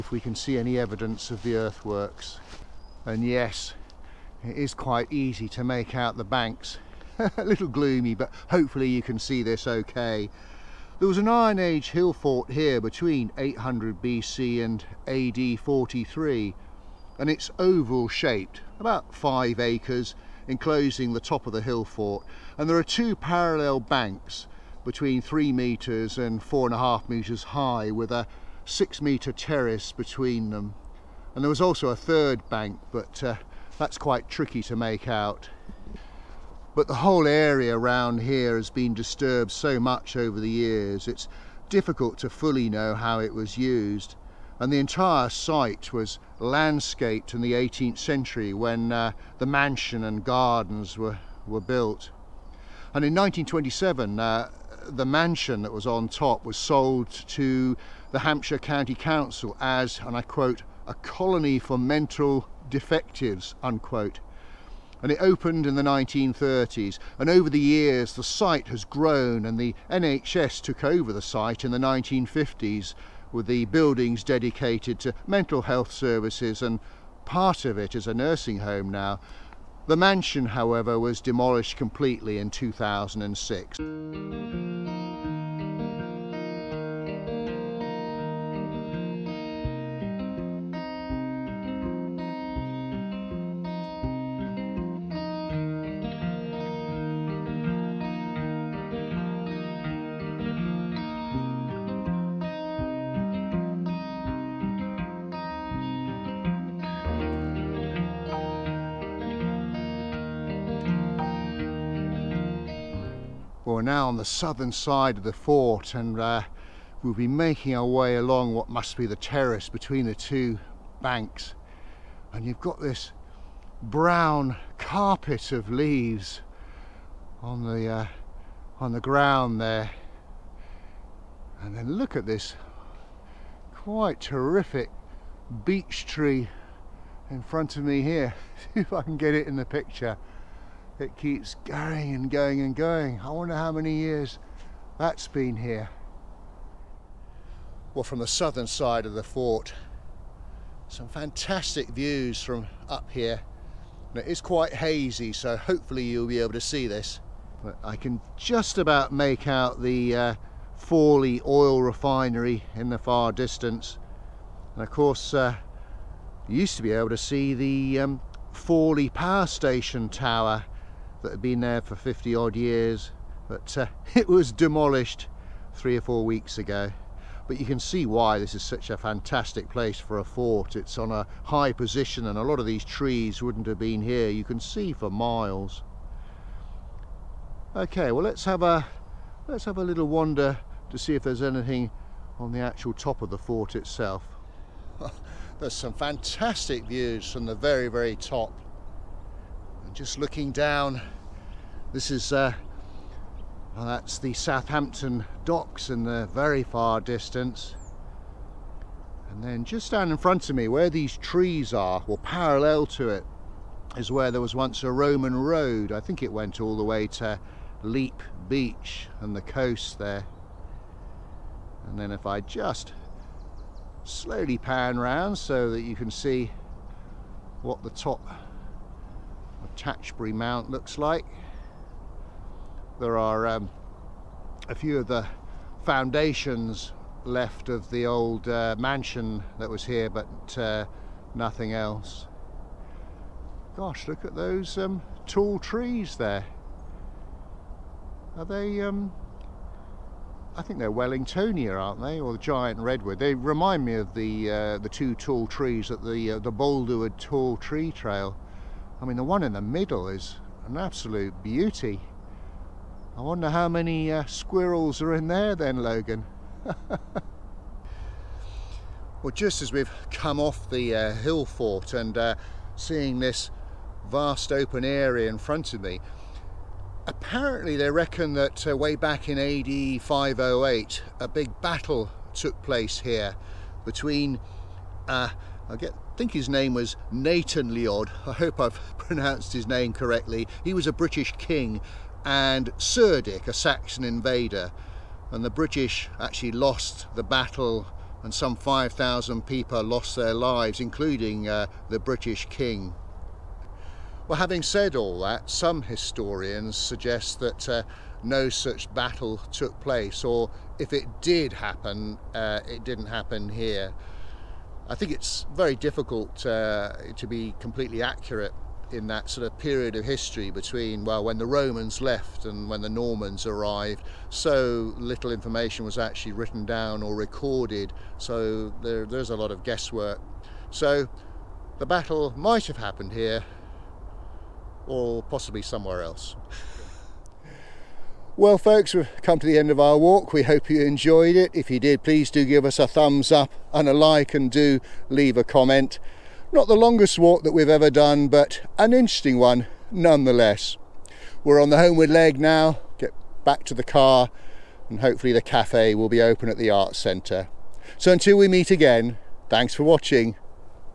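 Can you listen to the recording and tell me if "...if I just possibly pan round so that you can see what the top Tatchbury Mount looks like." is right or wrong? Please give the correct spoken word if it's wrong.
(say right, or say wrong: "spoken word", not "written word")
wrong: "slowly", not "possibly".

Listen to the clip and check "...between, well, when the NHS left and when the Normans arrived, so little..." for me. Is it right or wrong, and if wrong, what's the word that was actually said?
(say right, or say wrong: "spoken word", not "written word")
wrong: "Romans", not "NHS".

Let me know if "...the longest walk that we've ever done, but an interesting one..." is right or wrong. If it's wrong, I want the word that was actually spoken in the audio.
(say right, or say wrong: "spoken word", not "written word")
right.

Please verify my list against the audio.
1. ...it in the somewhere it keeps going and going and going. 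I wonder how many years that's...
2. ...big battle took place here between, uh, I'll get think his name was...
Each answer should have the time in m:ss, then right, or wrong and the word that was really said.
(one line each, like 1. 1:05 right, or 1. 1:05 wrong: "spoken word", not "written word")
1. 2:19 wrong: "picture", not "somewhere"
2. 4:41 right.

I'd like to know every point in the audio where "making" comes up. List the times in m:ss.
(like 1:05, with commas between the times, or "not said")
1:57.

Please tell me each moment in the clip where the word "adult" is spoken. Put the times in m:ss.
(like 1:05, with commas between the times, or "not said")
not said.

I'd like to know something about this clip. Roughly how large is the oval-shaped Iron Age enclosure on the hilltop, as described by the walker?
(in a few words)
5 acres.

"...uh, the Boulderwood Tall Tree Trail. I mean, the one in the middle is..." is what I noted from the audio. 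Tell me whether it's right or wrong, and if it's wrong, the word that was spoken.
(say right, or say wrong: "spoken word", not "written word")
right.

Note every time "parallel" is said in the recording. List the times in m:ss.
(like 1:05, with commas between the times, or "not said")
0:23, 3:32.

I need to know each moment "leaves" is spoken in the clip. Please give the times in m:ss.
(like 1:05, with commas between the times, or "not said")
2:05, 5:45.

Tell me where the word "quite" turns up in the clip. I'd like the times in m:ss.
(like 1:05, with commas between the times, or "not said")
0:04, 0:33, 2:13, 2:34.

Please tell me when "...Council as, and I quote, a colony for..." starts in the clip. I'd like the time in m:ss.
0:58.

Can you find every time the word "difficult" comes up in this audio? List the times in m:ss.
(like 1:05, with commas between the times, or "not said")
0:41, 5:15.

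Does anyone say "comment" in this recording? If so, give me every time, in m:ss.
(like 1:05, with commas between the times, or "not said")
5:45.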